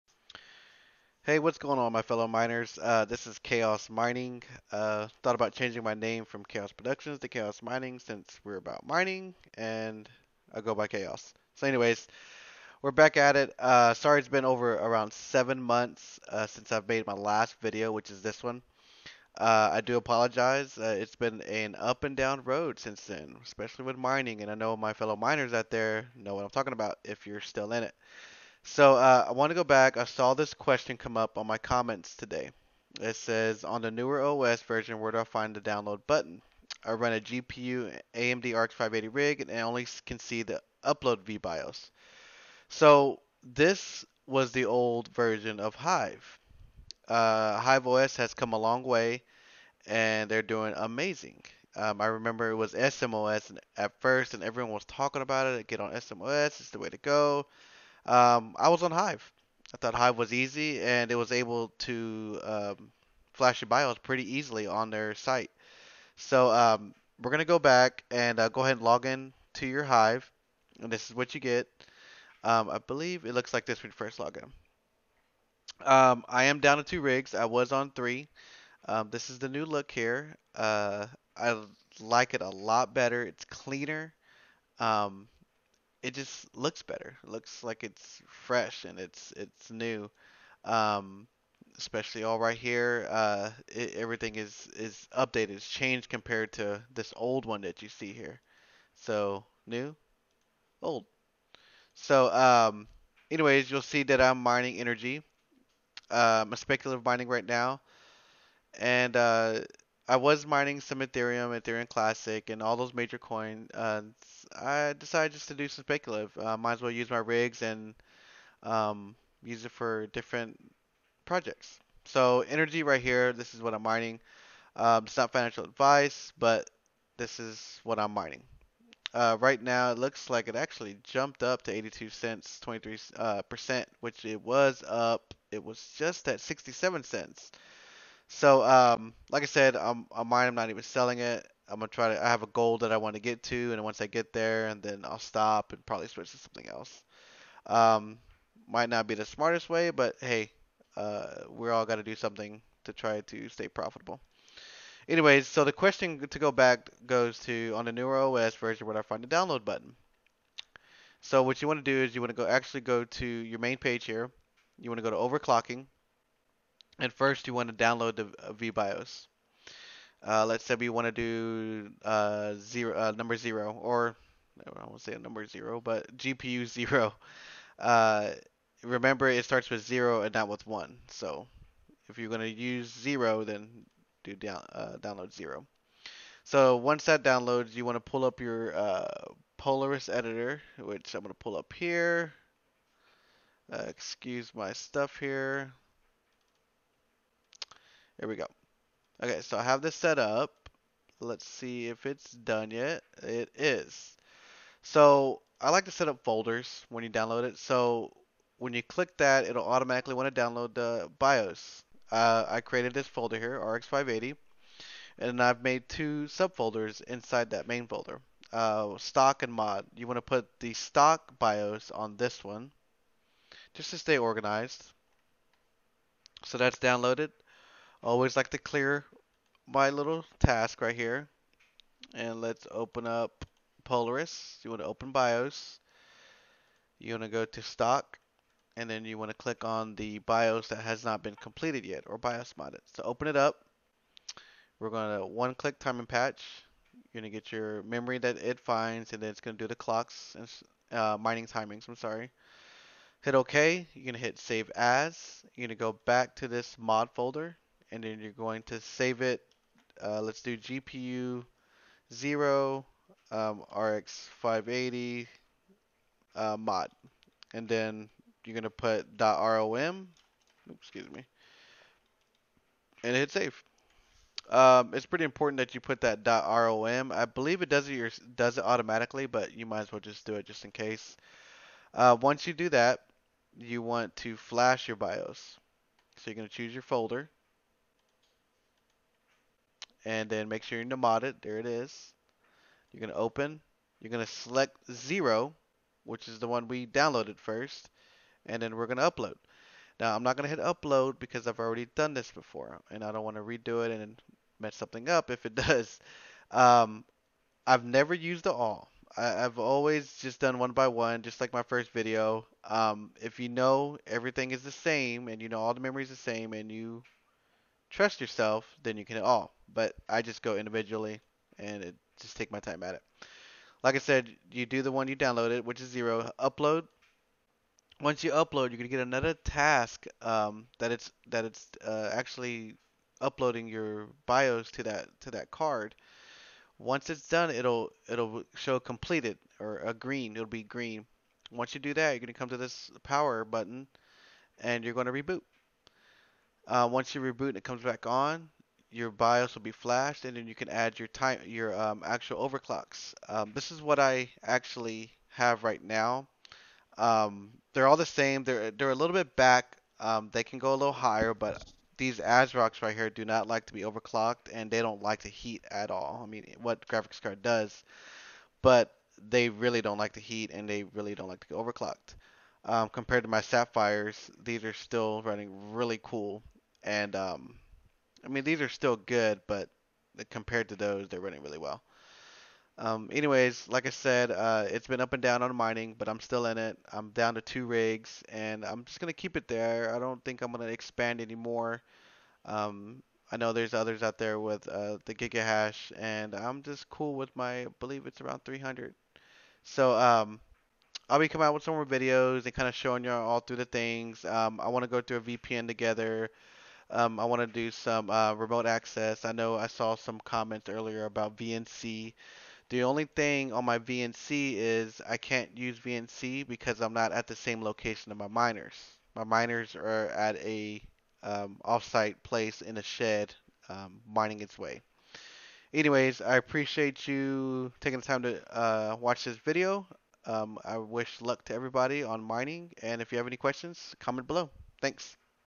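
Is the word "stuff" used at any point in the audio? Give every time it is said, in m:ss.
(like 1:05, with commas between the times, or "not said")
3:14.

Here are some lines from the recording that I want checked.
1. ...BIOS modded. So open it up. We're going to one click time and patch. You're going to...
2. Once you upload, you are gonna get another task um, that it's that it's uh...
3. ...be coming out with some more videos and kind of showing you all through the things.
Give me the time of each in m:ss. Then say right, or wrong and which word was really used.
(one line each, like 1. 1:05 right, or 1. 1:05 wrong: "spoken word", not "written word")
1. 4:02 right
2. 5:28 right
3. 6:41 right.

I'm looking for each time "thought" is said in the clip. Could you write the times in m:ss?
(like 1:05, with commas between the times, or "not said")
0:05, 0:59.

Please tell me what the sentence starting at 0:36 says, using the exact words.
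I run a GPU AMD RX 580 rig and I only can see the upload vBIOS.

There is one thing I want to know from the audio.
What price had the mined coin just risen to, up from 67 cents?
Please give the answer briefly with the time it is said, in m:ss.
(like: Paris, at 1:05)
82 cents, at 2:11.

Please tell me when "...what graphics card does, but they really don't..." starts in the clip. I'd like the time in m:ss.
6:06.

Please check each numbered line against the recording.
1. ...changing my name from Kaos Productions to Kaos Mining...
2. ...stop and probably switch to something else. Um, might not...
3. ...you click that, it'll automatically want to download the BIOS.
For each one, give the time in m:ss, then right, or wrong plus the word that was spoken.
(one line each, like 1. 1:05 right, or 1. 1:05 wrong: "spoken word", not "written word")
1. 0:05 right
2. 2:25 right
3. 3:28 right.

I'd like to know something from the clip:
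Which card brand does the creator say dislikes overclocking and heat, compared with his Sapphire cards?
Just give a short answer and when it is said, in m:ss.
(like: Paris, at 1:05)
ASRock, at 6:02.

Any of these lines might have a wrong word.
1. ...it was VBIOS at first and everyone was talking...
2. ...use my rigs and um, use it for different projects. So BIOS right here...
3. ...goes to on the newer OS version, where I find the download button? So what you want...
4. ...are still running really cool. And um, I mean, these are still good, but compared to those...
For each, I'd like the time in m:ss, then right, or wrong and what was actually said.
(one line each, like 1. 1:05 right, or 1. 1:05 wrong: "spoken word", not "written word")
1. 0:52 wrong: "SMOS", not "VBIOS"
2. 1:56 wrong: "Energi", not "BIOS"
3. 2:37 right
4. 6:14 right.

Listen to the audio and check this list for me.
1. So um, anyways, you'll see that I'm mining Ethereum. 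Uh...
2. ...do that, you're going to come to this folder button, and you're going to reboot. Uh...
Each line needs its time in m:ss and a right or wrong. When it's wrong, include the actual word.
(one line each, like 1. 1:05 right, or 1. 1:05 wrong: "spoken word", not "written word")
1. 1:41 wrong: "Energi", not "Ethereum"
2. 5:41 wrong: "power", not "folder".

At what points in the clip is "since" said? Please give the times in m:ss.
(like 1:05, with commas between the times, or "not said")
0:07, 0:16, 0:22.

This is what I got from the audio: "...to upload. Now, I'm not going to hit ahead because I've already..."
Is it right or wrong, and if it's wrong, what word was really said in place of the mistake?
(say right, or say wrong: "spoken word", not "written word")
wrong: "upload", not "ahead".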